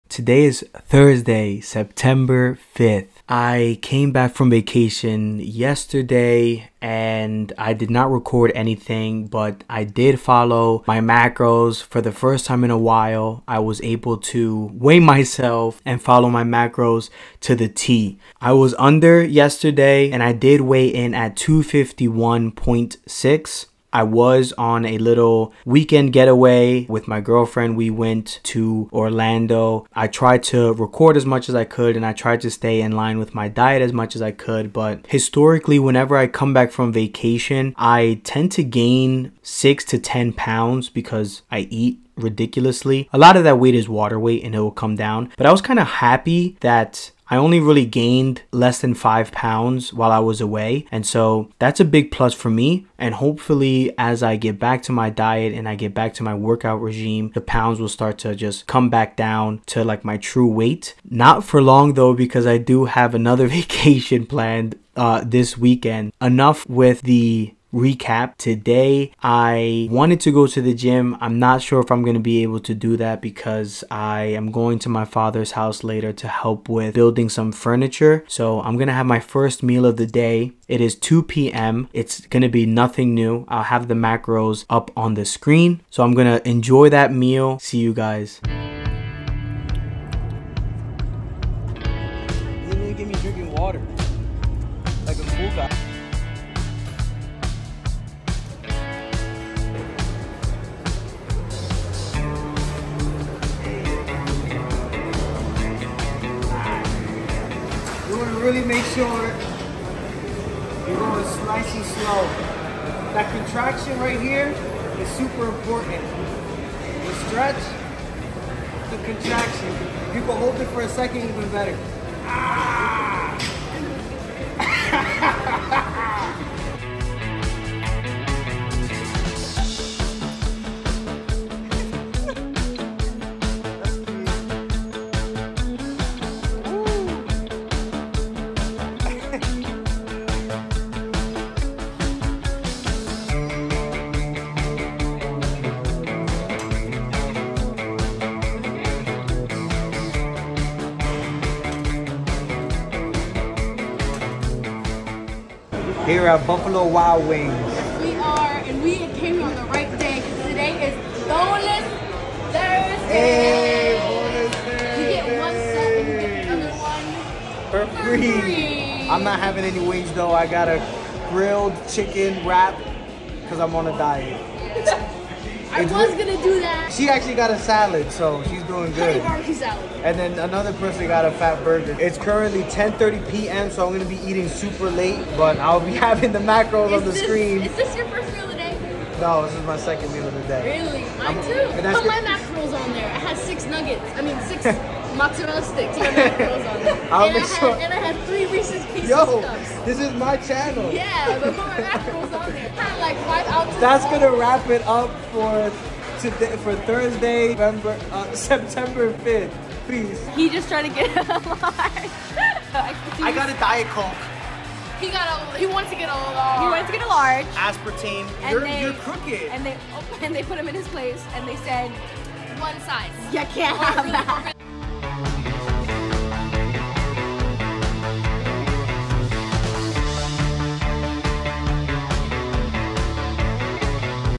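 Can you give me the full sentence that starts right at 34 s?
But historically, whenever I come back from vacation, I tend to gain six to 10 pounds because I eat ridiculously.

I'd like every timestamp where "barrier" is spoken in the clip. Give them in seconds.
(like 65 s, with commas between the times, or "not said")
not said.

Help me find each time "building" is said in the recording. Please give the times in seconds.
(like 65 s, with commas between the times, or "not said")
76 s.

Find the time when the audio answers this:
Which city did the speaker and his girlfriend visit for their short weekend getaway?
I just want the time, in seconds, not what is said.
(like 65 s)
28 s.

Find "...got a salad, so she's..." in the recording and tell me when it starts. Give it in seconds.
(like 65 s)
177 s.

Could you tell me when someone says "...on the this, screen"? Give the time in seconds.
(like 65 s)
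186 s.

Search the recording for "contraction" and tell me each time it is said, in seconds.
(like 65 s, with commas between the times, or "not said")
113 s, 119 s.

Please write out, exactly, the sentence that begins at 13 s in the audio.
I was able to weigh myself and follow my macros to the T.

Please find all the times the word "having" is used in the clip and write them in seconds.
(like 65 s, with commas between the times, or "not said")
169 s, 186 s.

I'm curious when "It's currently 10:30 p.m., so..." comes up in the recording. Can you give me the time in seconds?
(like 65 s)
181 s.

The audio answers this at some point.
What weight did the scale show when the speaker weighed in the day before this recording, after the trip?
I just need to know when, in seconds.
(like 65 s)
21 s.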